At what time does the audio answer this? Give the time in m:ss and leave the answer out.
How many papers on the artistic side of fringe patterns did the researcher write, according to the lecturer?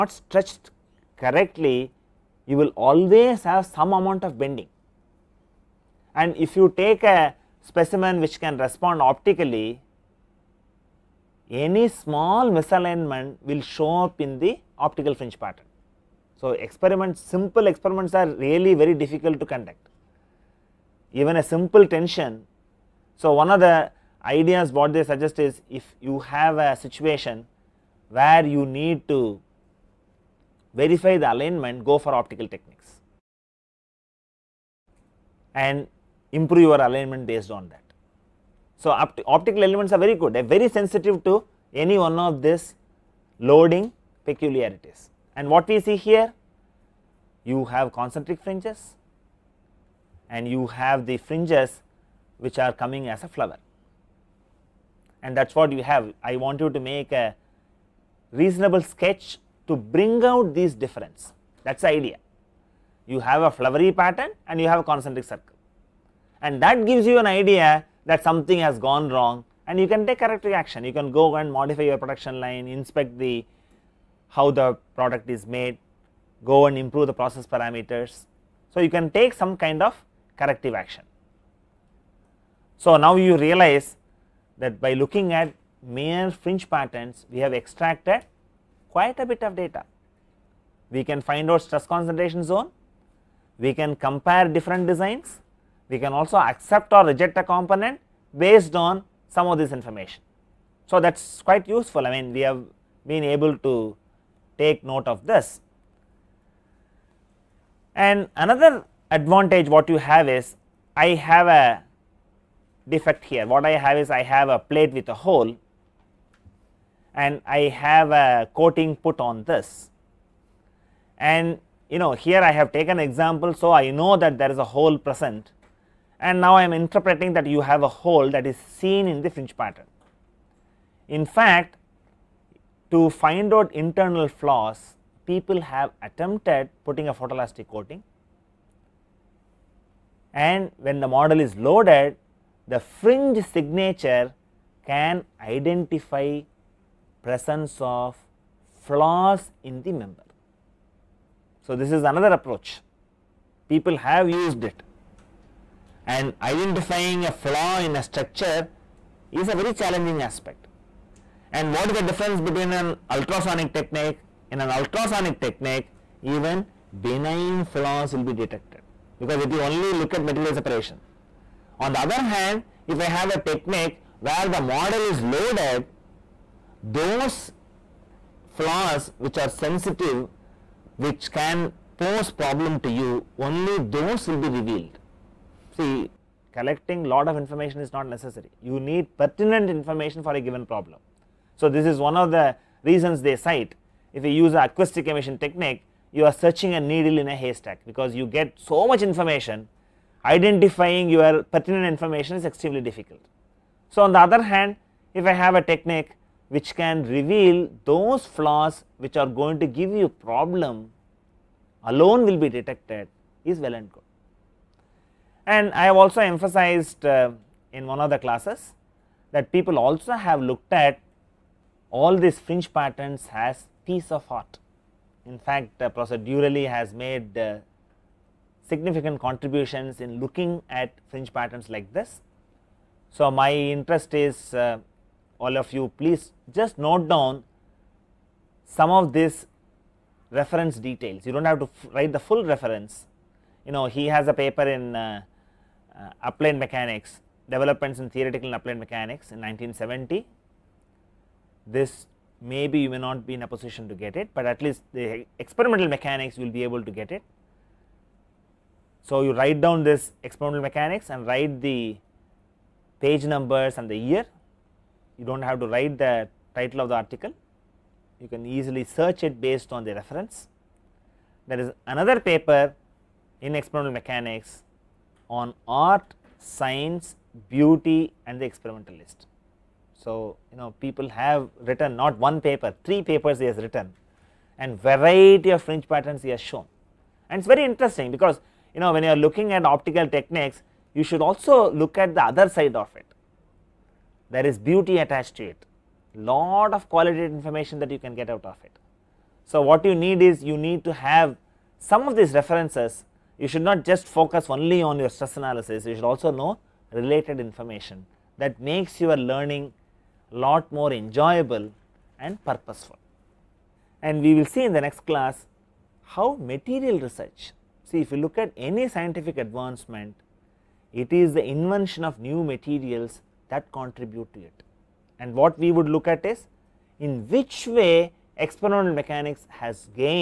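4:42.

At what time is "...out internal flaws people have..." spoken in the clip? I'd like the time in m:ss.
2:13.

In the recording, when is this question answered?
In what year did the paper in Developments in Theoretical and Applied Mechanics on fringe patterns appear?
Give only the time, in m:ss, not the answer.
4:09.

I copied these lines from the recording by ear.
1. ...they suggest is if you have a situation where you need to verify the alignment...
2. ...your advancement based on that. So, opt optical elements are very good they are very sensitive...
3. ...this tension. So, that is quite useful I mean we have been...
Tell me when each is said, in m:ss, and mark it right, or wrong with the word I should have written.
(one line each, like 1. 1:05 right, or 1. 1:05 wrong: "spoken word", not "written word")
1. 0:24 right
2. 0:36 wrong: "alignment", not "advancement"
3. 1:39 wrong: "information", not "tension".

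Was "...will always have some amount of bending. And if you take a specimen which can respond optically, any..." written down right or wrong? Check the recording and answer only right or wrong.
right.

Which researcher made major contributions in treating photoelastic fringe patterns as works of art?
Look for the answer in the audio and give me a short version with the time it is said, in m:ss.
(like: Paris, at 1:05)
Professor Durelli, at 3:45.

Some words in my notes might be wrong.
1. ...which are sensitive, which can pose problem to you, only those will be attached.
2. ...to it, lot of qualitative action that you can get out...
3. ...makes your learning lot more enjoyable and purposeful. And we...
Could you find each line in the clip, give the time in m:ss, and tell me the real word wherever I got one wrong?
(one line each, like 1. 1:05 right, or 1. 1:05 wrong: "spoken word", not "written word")
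1. 2:59 wrong: "revealed", not "attached"
2. 4:55 wrong: "information", not "action"
3. 5:08 right.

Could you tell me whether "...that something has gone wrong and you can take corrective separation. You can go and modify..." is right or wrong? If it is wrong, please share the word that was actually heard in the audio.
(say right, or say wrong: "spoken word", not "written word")
wrong: "action", not "separation".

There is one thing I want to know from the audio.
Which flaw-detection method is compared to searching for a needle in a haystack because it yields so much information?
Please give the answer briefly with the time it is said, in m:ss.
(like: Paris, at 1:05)
Acoustic emission, at 3:14.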